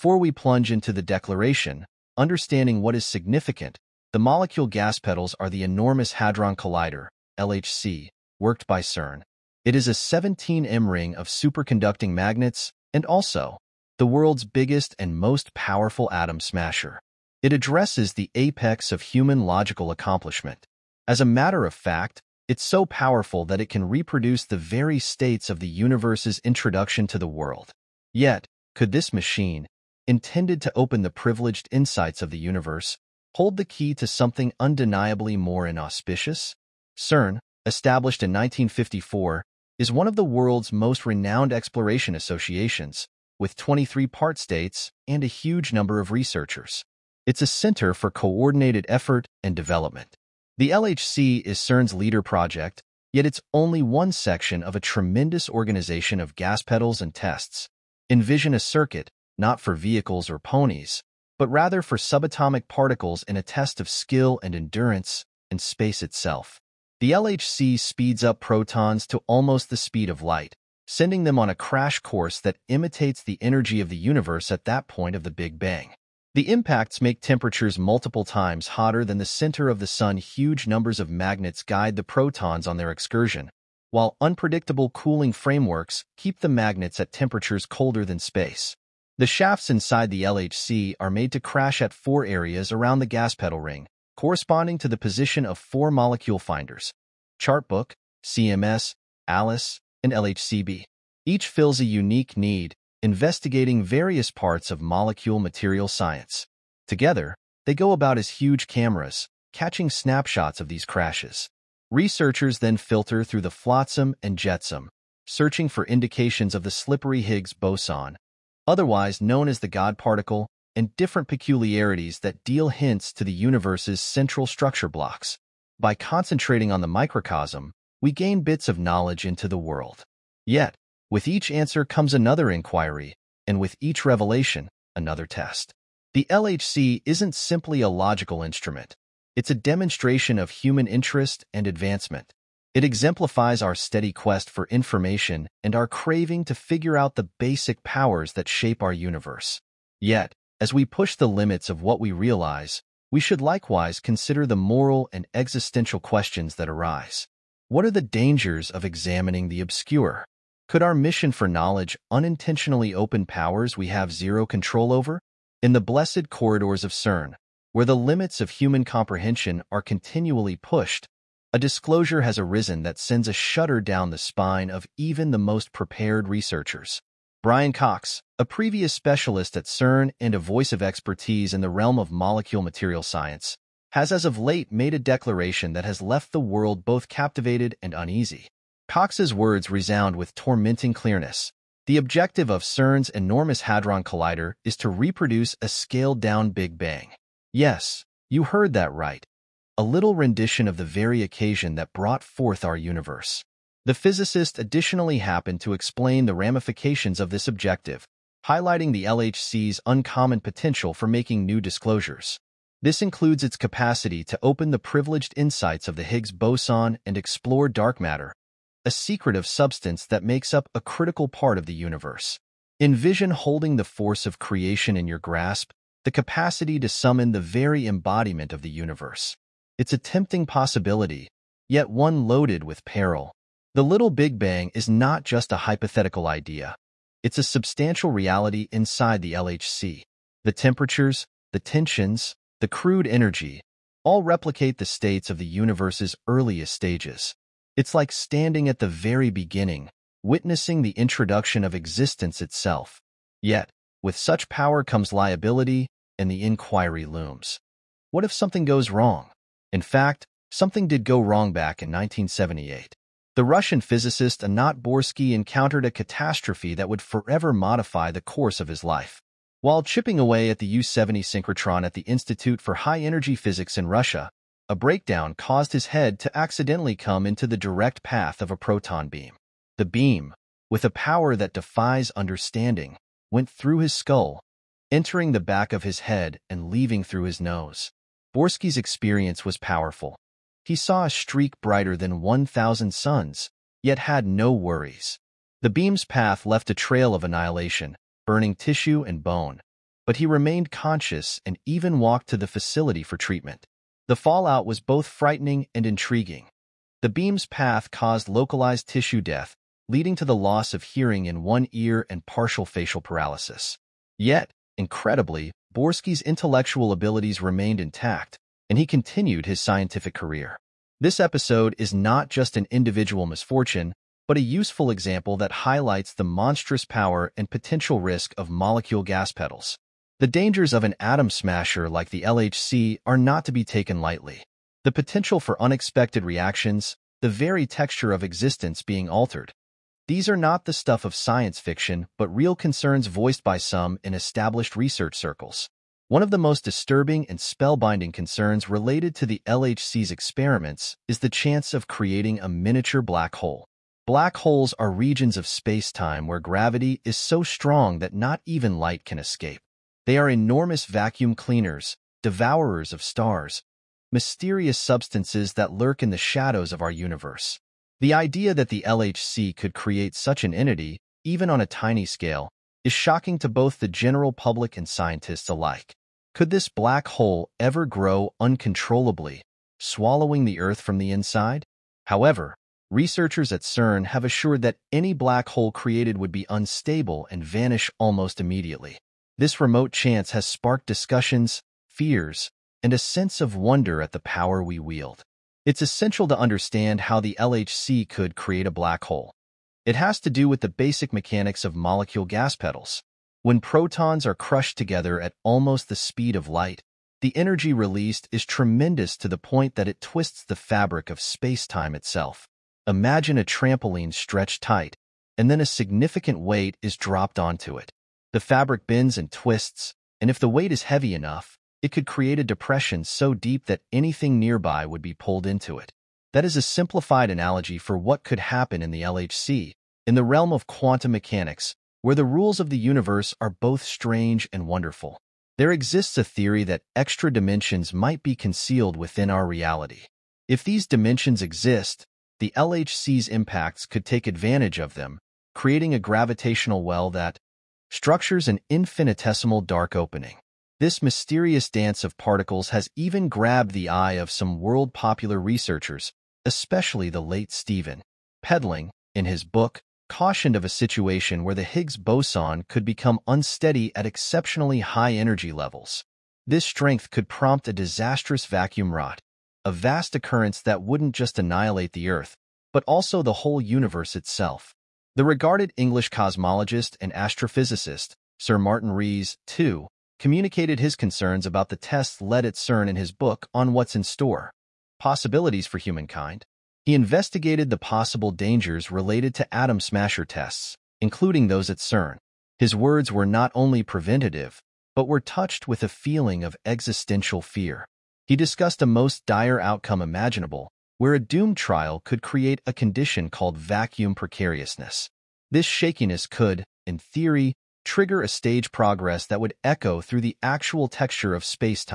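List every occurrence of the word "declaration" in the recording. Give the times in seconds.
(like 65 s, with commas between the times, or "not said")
1 s, 184 s.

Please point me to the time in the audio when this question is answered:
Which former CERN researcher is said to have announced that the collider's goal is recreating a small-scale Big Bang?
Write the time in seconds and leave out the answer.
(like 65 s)
177 s.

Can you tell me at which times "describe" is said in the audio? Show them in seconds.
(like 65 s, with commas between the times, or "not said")
not said.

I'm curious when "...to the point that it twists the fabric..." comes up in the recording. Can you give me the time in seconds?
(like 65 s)
409 s.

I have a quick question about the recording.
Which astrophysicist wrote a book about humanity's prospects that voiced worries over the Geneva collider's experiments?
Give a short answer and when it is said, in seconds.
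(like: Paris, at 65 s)
Sir Martin Rees, at 478 s.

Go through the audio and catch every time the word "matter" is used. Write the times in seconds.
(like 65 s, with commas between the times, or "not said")
21 s, 217 s.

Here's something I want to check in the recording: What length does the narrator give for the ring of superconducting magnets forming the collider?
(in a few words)
17M.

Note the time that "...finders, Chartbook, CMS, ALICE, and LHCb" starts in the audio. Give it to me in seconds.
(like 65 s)
96 s.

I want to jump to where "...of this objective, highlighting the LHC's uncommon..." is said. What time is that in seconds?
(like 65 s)
207 s.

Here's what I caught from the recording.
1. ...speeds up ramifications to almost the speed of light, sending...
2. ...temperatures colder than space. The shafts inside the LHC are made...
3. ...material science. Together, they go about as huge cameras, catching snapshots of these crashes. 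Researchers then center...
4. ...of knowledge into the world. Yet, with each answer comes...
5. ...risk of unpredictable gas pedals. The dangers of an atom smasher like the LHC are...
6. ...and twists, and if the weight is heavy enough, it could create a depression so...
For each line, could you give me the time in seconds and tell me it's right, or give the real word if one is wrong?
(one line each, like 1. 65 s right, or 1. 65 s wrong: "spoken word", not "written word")
1. 67 s wrong: "protons", not "ramifications"
2. 87 s right
3. 105 s wrong: "filter", not "center"
4. 128 s right
5. 327 s wrong: "molecule", not "unpredictable"
6. 419 s right.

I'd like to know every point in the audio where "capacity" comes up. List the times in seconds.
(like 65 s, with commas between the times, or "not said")
213 s, 226 s.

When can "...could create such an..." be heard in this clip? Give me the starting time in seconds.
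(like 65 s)
369 s.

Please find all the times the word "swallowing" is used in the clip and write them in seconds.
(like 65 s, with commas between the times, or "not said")
379 s.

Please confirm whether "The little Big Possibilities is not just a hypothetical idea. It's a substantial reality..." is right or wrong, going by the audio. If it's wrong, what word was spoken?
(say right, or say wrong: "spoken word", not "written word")
wrong: "Bang", not "Possibilities".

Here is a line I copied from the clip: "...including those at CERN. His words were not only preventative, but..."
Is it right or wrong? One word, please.
right.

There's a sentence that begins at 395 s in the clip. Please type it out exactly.
It's essential to understand how the LHC could create a black hole.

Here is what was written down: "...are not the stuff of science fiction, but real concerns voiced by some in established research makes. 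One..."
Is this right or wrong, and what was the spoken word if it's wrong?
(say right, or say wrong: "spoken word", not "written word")
wrong: "circles", not "makes".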